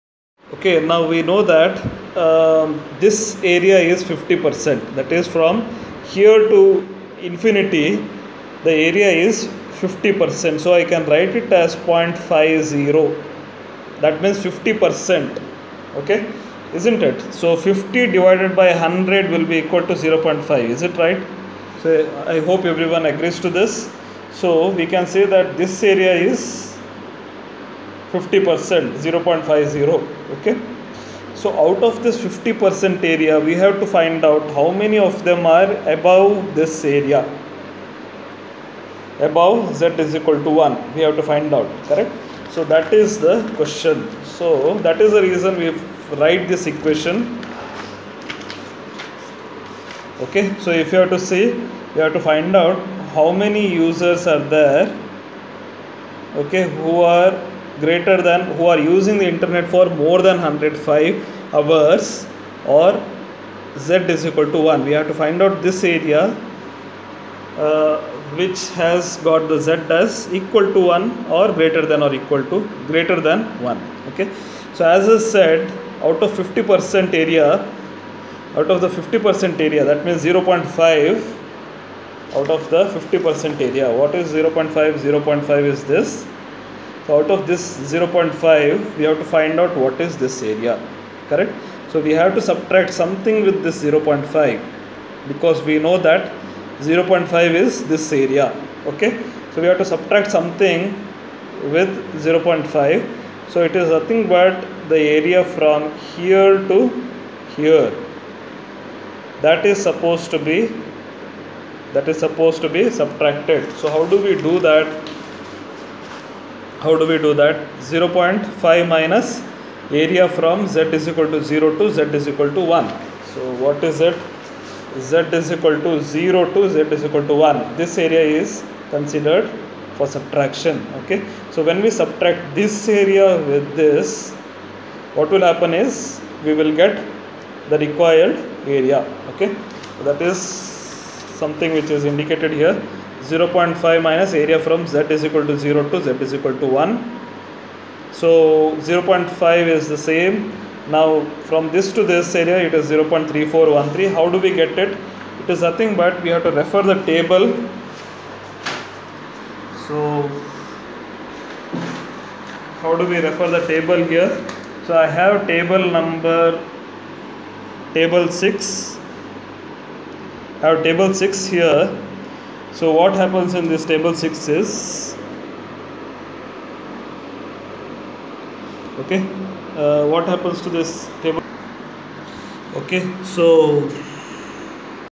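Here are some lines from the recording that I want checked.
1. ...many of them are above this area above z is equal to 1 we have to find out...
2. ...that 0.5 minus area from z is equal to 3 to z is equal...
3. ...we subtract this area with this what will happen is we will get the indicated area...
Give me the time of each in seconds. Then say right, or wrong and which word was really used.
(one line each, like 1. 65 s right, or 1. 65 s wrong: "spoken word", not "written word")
1. 34 s right
2. 117 s wrong: "0", not "3"
3. 131 s wrong: "required", not "indicated".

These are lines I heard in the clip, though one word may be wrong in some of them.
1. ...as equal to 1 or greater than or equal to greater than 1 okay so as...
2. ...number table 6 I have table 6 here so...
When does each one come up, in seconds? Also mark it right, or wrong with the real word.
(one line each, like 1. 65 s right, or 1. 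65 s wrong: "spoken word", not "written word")
1. 69 s right
2. 165 s right.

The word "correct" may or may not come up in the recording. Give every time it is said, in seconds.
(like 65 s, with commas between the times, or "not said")
41 s, 91 s.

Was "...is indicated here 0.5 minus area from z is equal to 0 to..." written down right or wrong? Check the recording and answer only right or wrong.
right.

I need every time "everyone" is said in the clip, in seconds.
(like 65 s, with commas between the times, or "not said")
22 s.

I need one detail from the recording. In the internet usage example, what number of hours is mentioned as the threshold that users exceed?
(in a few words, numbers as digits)
105.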